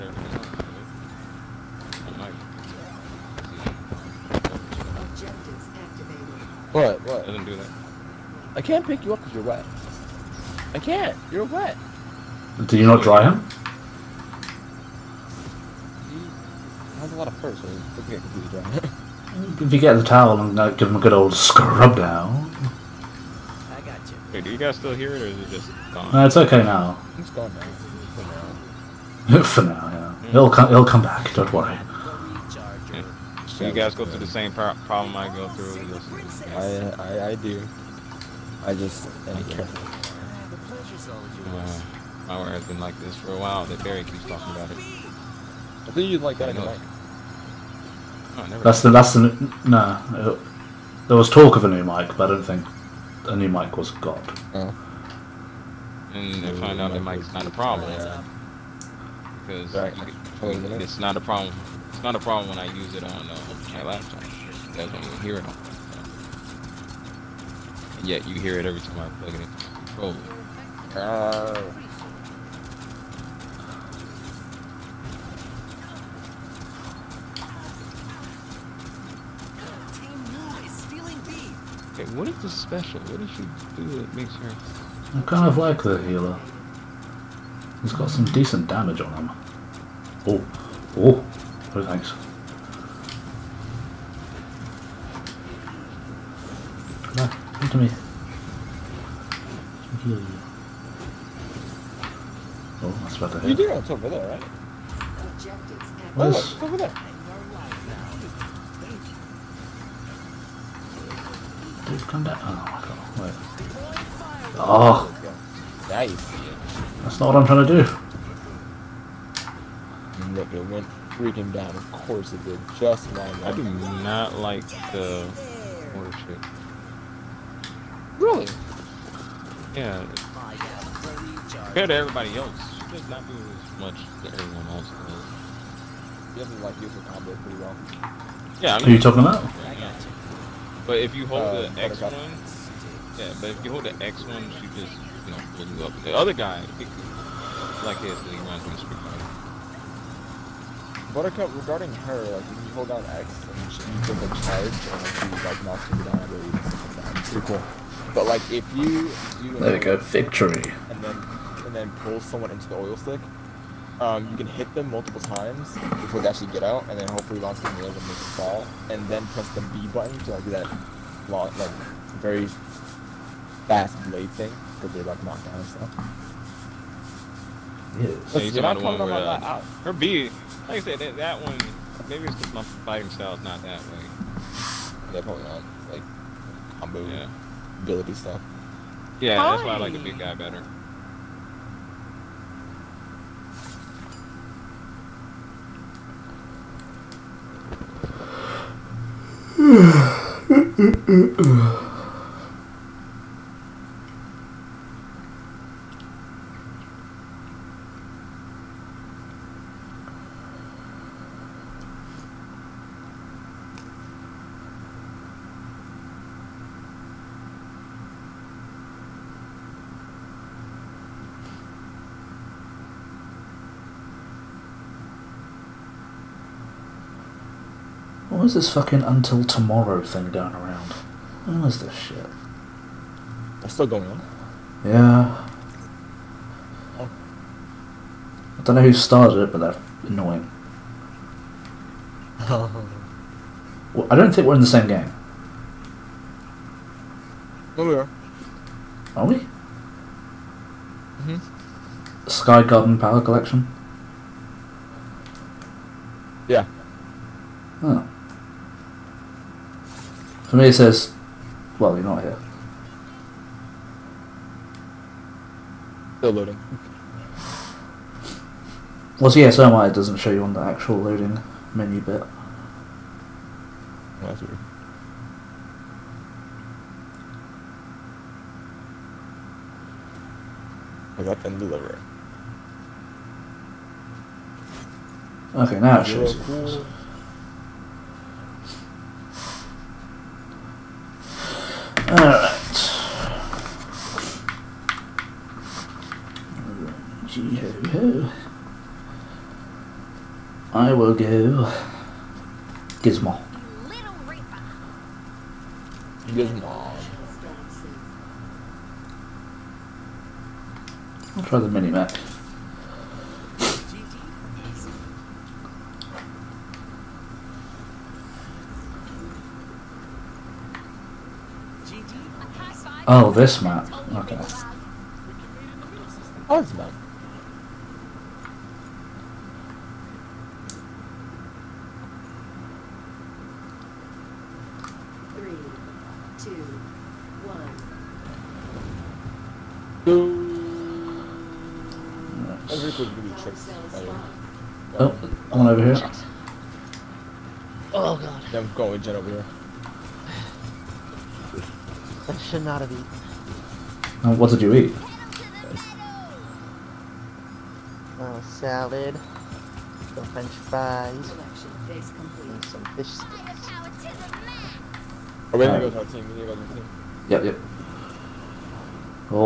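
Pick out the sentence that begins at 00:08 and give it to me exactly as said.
I can't pick you up because you're wet.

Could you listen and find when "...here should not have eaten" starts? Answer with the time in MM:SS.
05:49.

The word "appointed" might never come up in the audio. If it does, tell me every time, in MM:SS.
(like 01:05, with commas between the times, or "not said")
not said.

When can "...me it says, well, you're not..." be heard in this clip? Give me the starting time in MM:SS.
04:20.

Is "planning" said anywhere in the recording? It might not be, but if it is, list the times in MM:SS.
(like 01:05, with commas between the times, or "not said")
not said.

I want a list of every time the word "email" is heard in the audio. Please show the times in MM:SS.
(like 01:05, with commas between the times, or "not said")
not said.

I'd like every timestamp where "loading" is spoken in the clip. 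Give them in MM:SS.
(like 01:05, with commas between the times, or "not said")
04:26, 04:30.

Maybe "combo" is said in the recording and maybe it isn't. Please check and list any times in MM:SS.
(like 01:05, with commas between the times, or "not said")
02:17, 03:06.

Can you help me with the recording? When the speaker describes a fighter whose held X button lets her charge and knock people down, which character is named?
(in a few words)
Buttercup.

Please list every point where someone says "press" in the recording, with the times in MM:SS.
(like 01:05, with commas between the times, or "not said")
02:49.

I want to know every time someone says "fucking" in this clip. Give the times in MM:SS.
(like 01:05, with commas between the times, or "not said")
03:48.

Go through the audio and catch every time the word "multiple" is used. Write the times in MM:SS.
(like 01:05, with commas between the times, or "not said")
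02:44.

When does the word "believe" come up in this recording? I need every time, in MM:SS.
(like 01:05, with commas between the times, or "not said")
02:36.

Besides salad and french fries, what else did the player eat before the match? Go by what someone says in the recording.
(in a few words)
fish sticks.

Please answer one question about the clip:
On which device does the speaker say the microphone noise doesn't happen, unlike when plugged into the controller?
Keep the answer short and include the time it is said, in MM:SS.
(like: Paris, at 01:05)
laptop, at 01:03.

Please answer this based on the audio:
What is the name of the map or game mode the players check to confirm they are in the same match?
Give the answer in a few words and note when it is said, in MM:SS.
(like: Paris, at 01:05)
Sky Garden Power Collection, at 04:12.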